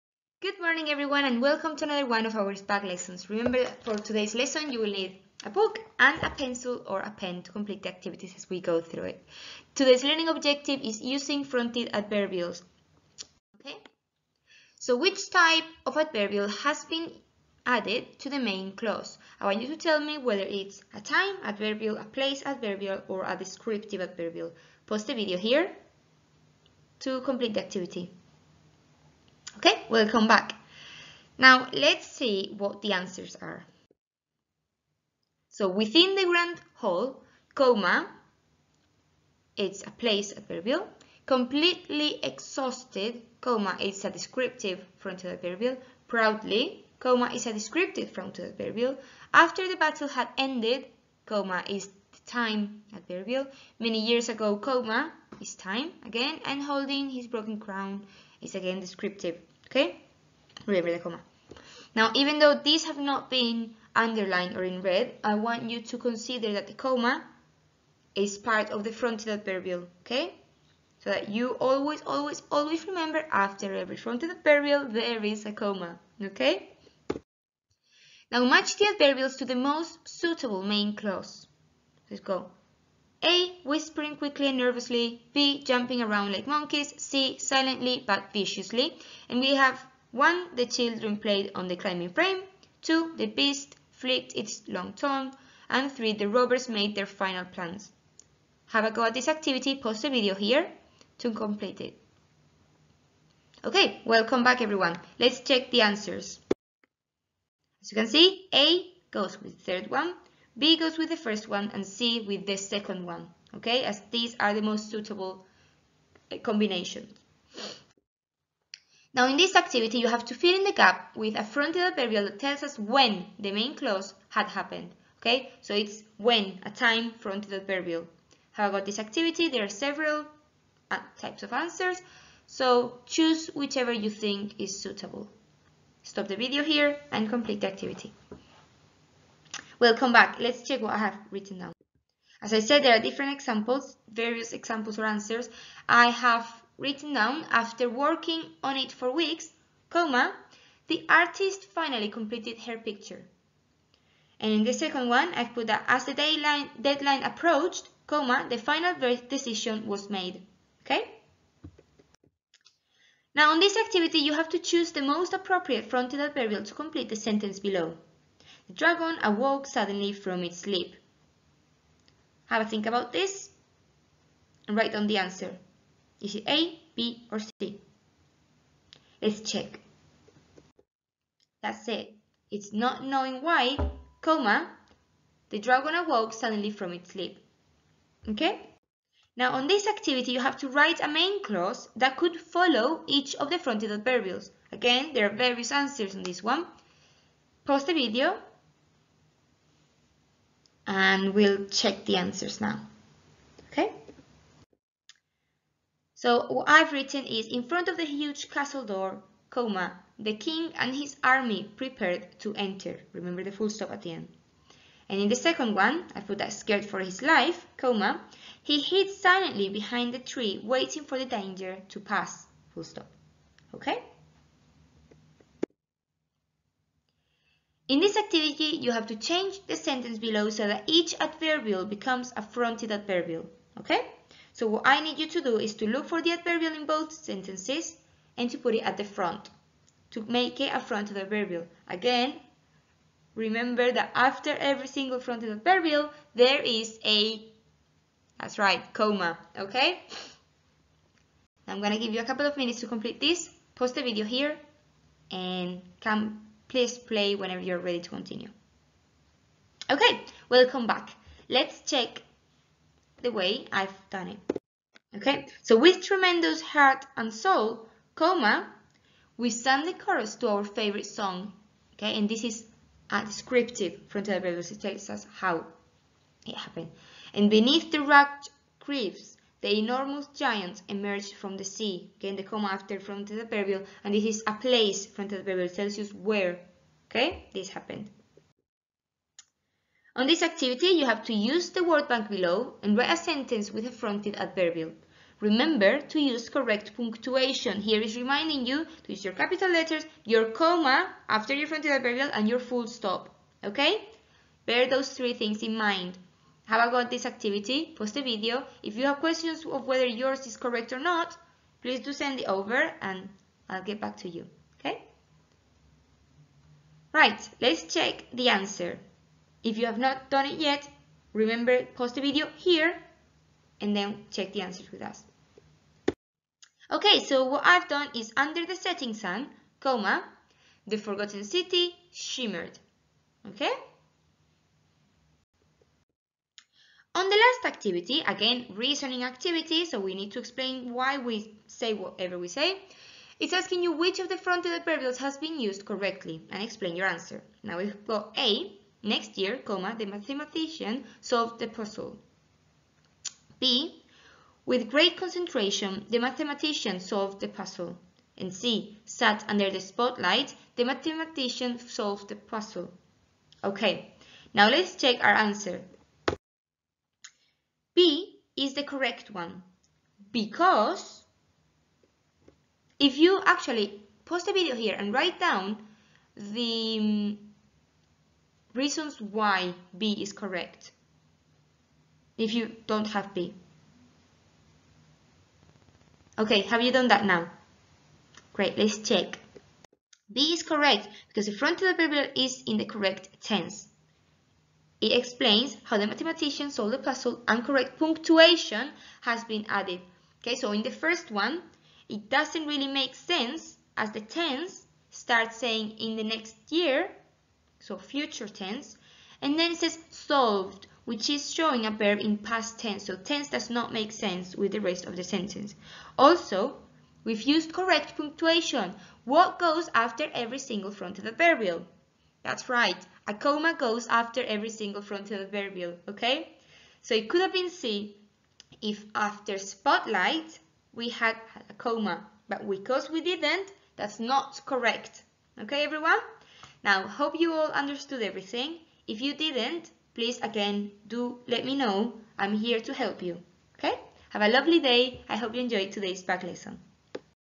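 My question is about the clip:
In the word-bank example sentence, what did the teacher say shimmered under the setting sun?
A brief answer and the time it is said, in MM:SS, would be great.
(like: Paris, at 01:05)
The forgotten city, at 05:30.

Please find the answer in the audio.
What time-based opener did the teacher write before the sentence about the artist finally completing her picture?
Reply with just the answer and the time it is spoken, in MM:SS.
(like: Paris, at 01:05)
After working on it for weeks, at 02:27.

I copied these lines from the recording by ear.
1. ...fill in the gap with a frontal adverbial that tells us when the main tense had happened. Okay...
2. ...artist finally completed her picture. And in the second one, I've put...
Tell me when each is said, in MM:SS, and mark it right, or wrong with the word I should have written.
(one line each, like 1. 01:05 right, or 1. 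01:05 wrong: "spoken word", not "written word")
1. 02:00 wrong: "clause", not "tense"
2. 02:31 right.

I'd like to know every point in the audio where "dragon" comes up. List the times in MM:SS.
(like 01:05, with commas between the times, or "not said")
02:48, 03:05.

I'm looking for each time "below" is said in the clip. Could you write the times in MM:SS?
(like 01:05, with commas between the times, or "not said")
02:47, 03:50, 04:52.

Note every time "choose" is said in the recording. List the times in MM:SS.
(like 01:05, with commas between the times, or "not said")
02:13, 02:44.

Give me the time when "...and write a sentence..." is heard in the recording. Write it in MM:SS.
04:52.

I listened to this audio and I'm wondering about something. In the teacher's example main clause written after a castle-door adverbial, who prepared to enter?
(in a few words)
The king and his army.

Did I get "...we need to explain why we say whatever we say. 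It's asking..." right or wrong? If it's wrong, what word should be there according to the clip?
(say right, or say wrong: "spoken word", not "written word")
right.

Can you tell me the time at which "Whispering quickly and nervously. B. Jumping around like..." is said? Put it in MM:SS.
01:23.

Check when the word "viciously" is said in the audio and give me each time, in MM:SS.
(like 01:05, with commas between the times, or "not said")
01:28.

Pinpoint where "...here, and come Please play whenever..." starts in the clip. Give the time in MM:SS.
04:14.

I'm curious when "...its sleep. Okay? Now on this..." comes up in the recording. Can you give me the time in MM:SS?
03:06.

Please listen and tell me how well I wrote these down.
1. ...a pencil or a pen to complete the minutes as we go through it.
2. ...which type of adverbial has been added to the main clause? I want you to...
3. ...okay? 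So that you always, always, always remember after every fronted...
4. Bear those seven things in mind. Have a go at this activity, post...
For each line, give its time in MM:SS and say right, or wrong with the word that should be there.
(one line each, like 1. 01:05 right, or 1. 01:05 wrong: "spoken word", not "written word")
1. 00:06 wrong: "activities", not "minutes"
2. 00:14 right
3. 01:10 right
4. 05:04 wrong: "three", not "seven".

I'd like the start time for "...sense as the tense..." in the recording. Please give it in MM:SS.
06:43.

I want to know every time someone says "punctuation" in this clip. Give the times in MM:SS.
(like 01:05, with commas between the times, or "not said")
04:56, 06:37, 06:58.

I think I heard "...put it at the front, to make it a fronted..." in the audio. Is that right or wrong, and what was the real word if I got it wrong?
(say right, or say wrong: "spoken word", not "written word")
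right.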